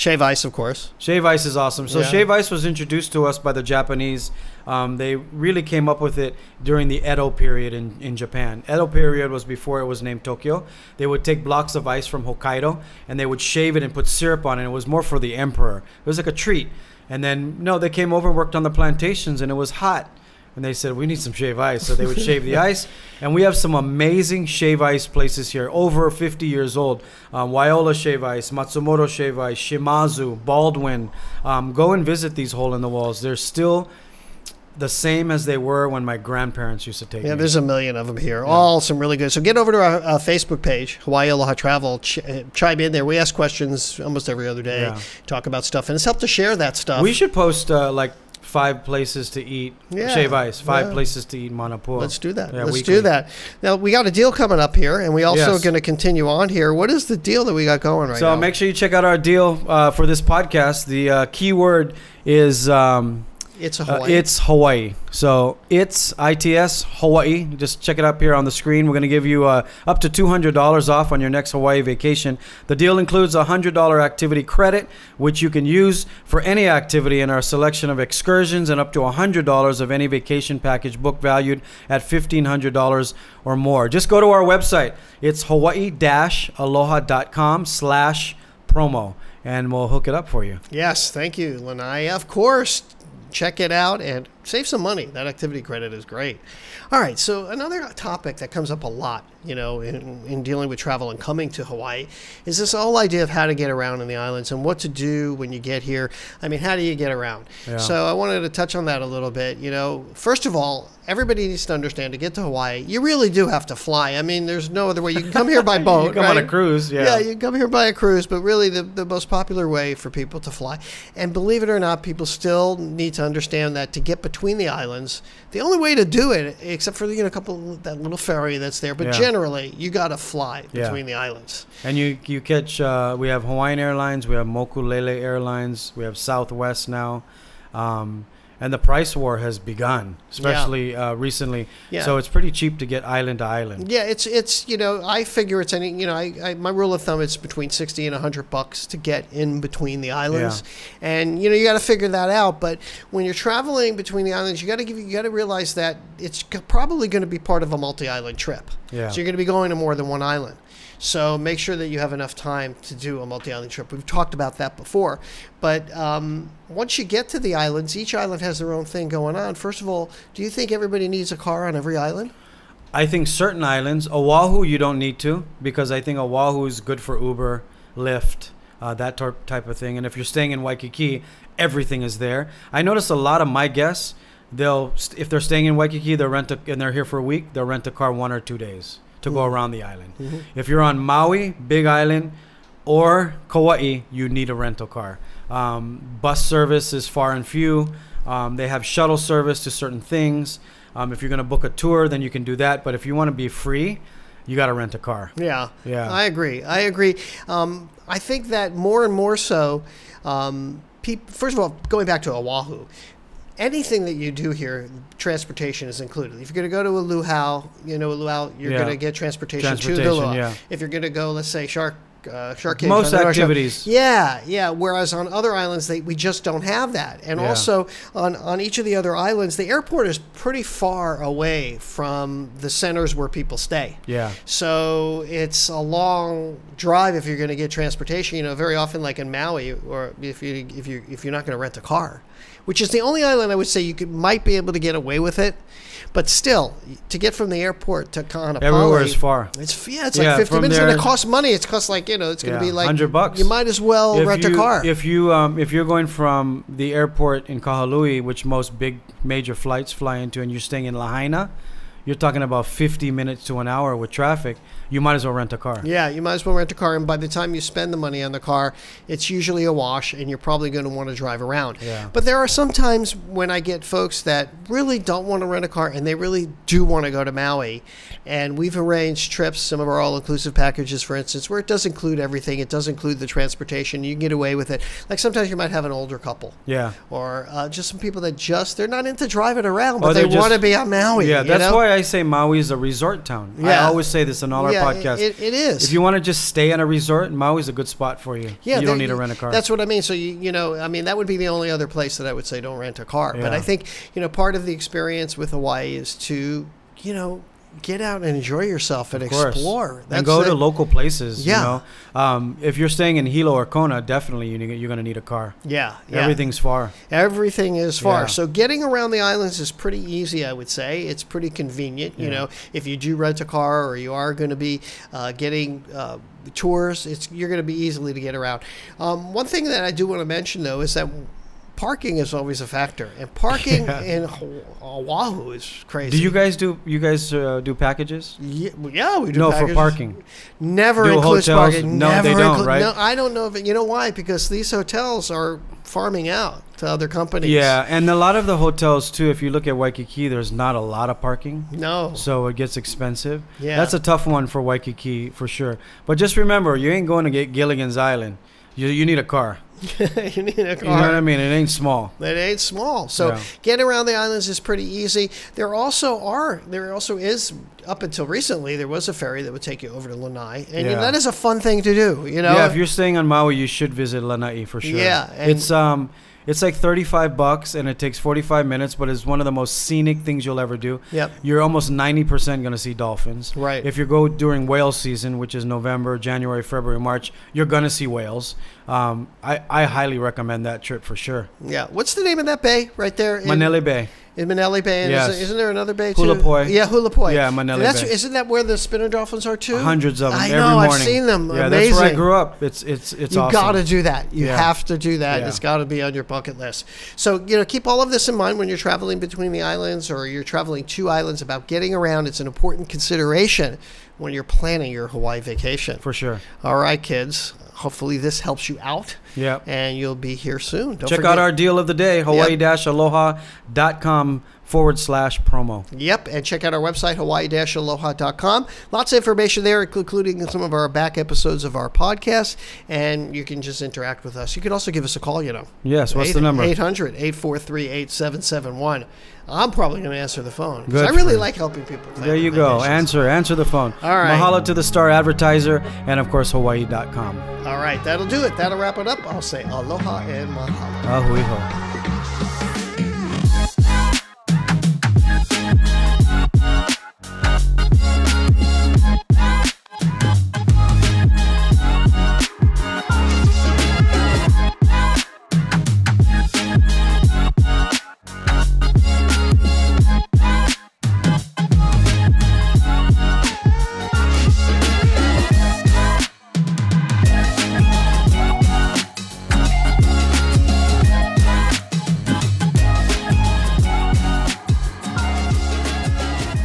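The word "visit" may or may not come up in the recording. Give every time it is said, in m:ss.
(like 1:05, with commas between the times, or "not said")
0:32, 6:13.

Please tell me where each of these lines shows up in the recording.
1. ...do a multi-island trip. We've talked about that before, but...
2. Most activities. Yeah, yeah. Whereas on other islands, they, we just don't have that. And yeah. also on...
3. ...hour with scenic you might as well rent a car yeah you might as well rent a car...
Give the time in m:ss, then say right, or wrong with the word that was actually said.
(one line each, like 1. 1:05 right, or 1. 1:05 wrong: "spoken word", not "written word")
1. 2:42 right
2. 3:42 right
3. 4:23 wrong: "traffic", not "scenic".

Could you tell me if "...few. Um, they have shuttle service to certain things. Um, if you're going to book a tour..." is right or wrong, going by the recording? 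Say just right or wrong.
right.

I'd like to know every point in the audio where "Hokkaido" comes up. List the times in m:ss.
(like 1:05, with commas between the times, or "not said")
0:12.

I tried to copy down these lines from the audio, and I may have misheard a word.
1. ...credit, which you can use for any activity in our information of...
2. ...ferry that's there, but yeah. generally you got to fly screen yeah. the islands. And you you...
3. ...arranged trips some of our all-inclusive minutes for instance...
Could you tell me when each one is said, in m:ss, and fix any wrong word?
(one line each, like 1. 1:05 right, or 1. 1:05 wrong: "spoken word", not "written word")
1. 1:14 wrong: "selection", not "information"
2. 2:08 wrong: "between", not "screen"
3. 4:38 wrong: "packages", not "minutes".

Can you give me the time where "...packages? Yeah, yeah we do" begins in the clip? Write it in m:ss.
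5:37.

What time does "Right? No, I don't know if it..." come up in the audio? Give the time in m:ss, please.
5:42.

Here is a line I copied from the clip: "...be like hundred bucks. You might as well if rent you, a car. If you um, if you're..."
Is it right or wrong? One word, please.
right.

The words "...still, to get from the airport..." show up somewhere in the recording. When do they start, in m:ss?
4:06.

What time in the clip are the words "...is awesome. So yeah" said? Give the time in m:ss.
0:01.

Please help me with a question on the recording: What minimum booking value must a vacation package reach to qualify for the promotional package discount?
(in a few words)
$1,500.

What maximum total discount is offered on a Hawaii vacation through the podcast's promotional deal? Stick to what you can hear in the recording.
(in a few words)
$200.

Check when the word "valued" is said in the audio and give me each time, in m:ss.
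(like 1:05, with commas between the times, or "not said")
1:21.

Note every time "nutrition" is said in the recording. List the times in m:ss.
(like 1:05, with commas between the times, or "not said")
not said.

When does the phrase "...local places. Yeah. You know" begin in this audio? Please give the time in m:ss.
5:10.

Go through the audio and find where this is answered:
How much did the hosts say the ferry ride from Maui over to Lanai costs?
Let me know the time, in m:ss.
6:16.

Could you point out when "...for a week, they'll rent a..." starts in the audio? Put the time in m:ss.
3:07.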